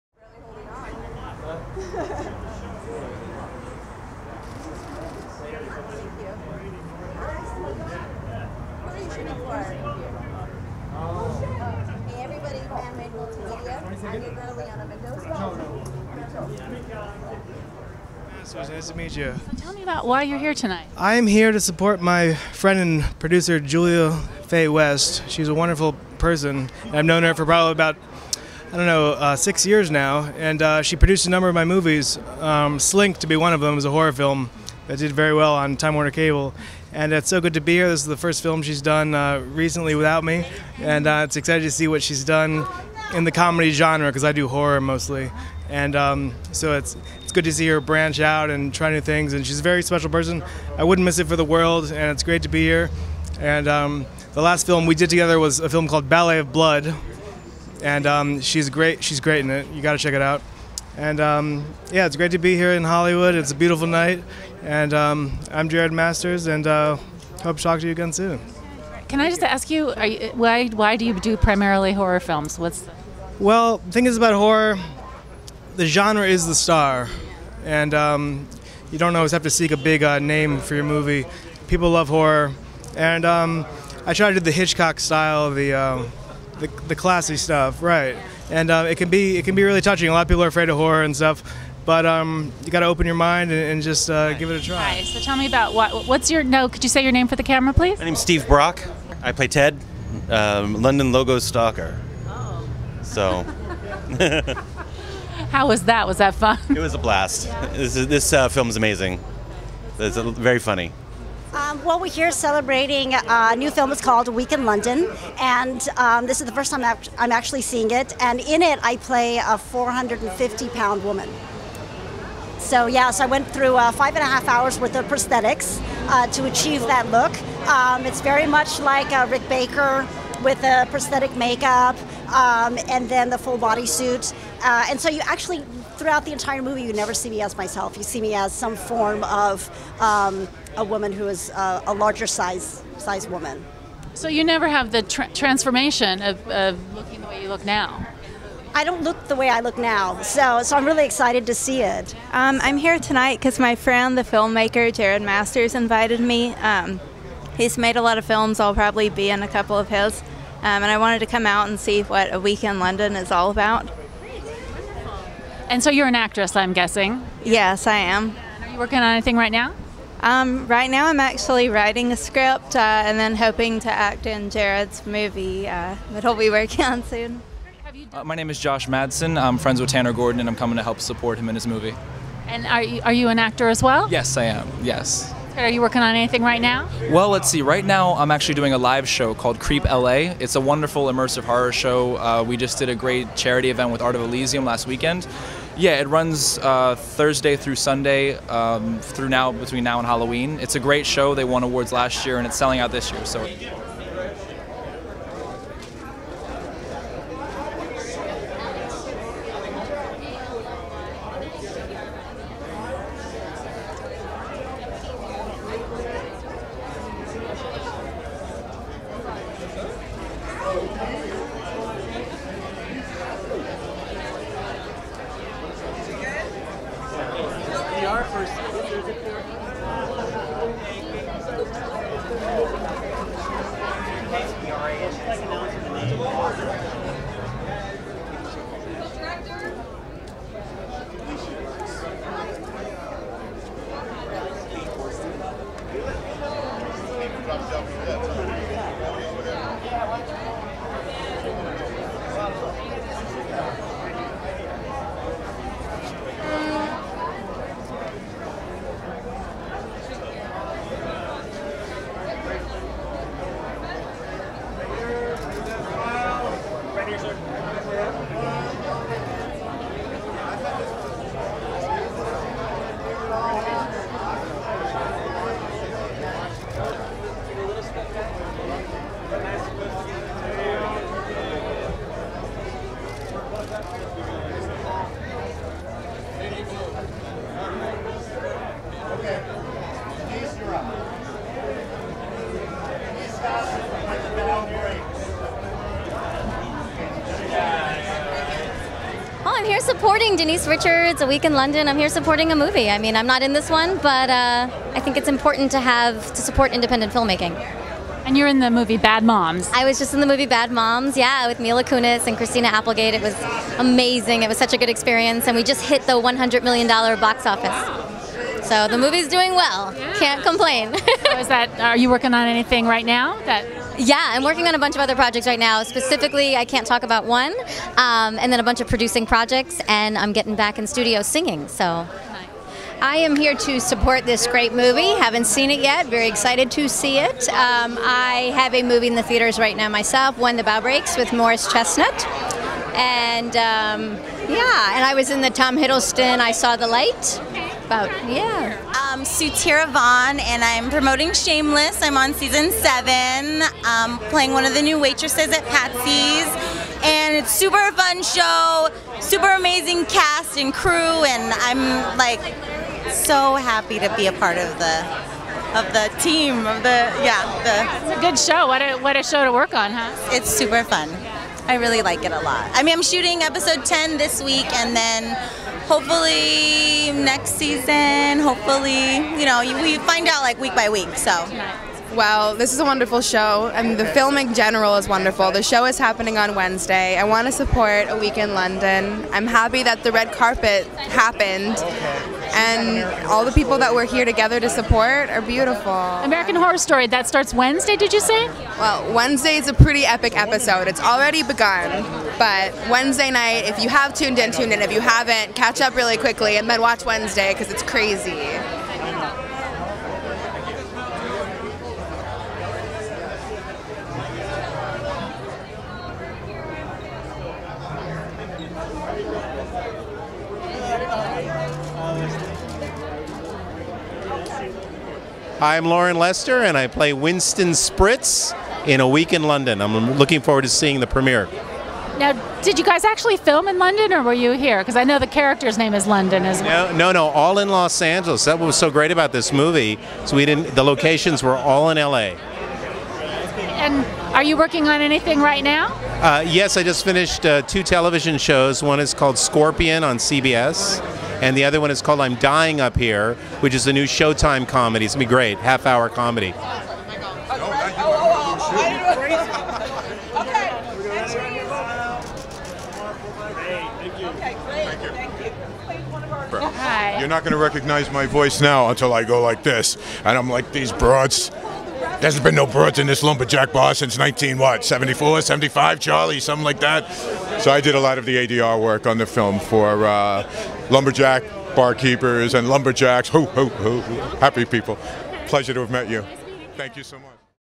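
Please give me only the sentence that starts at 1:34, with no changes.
Hi, so tell me about what what's your no?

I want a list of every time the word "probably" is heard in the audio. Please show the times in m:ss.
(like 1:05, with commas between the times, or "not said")
0:27, 2:38.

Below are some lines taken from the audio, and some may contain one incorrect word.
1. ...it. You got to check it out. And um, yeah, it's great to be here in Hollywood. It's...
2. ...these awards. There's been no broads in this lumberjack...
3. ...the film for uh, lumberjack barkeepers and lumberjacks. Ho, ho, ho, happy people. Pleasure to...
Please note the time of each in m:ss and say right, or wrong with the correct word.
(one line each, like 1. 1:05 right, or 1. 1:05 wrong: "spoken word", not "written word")
1. 0:59 right
2. 7:50 wrong: "broads", not "awards"
3. 7:59 right.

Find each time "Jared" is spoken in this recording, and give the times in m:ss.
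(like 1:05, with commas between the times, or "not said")
1:05, 2:34, 2:54.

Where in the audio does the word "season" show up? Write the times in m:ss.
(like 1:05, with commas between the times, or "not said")
5:52, 6:17.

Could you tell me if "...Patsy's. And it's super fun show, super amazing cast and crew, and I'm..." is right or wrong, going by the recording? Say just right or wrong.
right.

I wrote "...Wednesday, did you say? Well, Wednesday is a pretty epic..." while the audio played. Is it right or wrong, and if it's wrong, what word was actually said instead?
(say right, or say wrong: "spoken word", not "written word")
right.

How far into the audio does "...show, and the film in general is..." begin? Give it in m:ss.
6:23.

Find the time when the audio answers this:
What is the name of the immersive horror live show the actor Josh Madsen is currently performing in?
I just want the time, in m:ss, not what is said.
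3:09.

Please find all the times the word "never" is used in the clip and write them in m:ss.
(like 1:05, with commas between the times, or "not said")
2:16, 2:24.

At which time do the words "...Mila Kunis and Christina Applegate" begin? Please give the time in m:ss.
5:11.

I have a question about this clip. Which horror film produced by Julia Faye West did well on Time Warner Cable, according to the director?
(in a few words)
Slink.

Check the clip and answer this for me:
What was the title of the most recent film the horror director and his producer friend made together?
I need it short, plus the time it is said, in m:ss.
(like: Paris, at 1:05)
Ballet of Blood, at 0:56.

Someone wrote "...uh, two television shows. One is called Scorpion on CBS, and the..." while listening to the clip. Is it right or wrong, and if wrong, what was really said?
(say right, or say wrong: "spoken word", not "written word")
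right.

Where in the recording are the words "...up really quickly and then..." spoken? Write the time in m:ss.
6:45.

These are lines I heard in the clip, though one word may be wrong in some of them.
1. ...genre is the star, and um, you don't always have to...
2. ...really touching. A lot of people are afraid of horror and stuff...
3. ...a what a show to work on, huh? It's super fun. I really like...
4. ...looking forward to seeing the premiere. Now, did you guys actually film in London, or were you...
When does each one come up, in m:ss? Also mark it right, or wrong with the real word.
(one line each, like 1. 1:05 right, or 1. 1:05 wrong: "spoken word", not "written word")
1. 1:15 right
2. 1:29 right
3. 6:08 right
4. 7:10 right.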